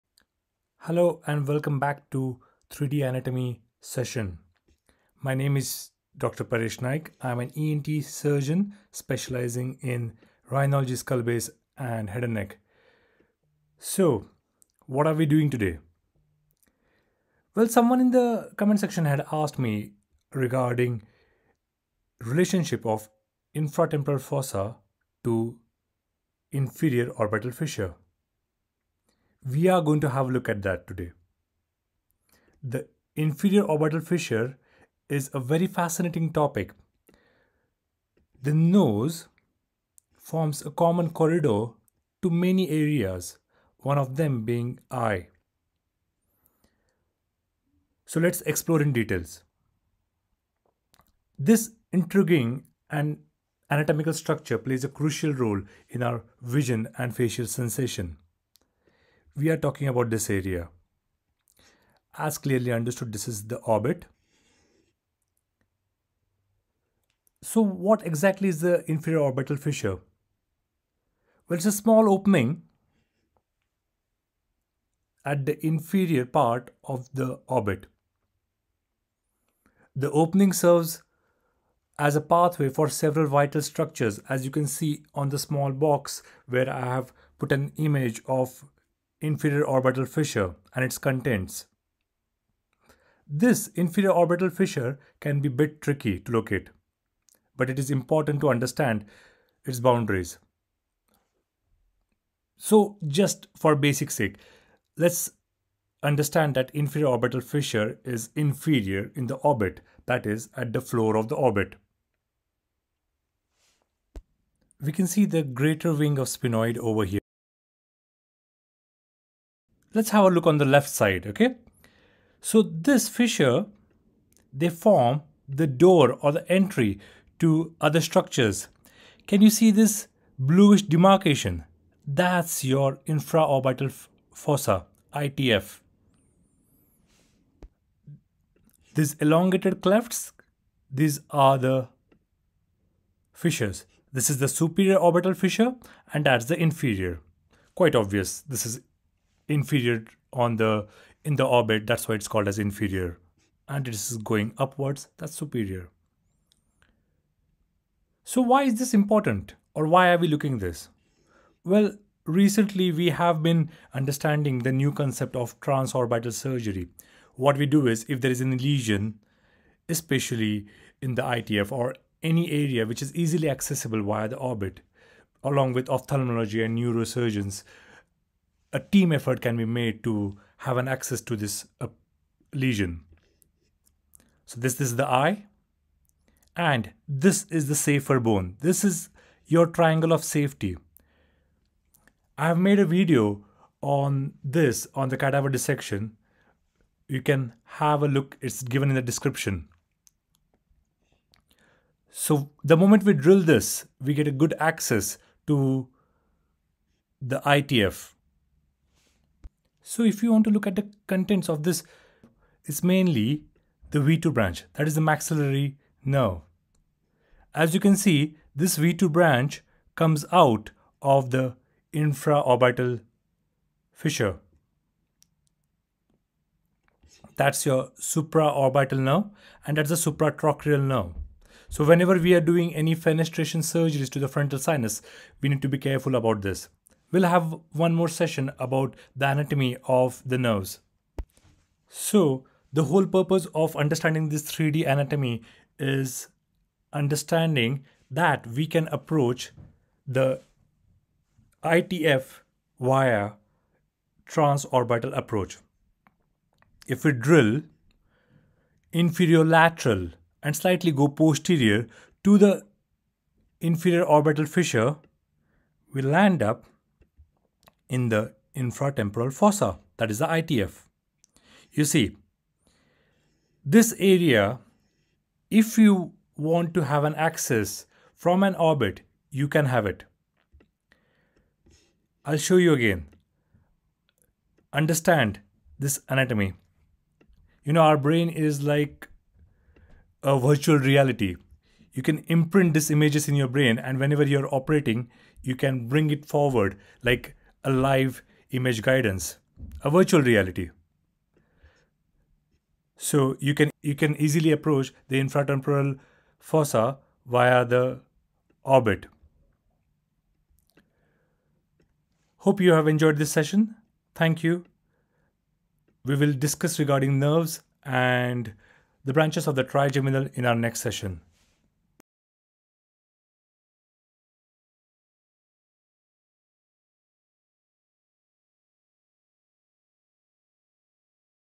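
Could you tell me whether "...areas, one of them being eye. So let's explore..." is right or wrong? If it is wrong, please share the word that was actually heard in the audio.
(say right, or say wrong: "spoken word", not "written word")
right.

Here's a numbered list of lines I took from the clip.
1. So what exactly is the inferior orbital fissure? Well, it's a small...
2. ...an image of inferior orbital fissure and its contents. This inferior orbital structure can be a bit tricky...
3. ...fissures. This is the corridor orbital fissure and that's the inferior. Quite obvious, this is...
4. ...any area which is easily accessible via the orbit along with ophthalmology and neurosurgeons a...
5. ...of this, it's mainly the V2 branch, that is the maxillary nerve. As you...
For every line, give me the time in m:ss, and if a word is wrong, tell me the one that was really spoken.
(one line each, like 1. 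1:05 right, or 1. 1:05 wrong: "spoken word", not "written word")
1. 1:07 right
2. 1:27 wrong: "fissure", not "structure"
3. 2:23 wrong: "superior", not "corridor"
4. 2:52 right
5. 3:31 right.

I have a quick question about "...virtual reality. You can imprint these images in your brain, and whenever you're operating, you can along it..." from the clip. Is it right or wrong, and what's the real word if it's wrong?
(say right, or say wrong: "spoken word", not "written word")
wrong: "bring", not "along".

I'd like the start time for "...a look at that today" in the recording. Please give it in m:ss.
0:30.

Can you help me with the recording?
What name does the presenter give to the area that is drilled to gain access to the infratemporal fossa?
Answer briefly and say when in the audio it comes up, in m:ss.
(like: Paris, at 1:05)
Triangle of safety, at 3:09.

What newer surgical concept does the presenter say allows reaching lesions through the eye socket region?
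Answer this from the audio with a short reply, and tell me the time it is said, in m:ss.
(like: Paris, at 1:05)
Transorbital surgery, at 2:45.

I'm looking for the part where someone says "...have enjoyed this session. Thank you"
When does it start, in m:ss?
5:12.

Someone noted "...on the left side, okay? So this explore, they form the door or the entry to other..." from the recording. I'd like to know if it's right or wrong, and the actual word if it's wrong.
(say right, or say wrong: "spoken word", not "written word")
wrong: "fissure", not "explore".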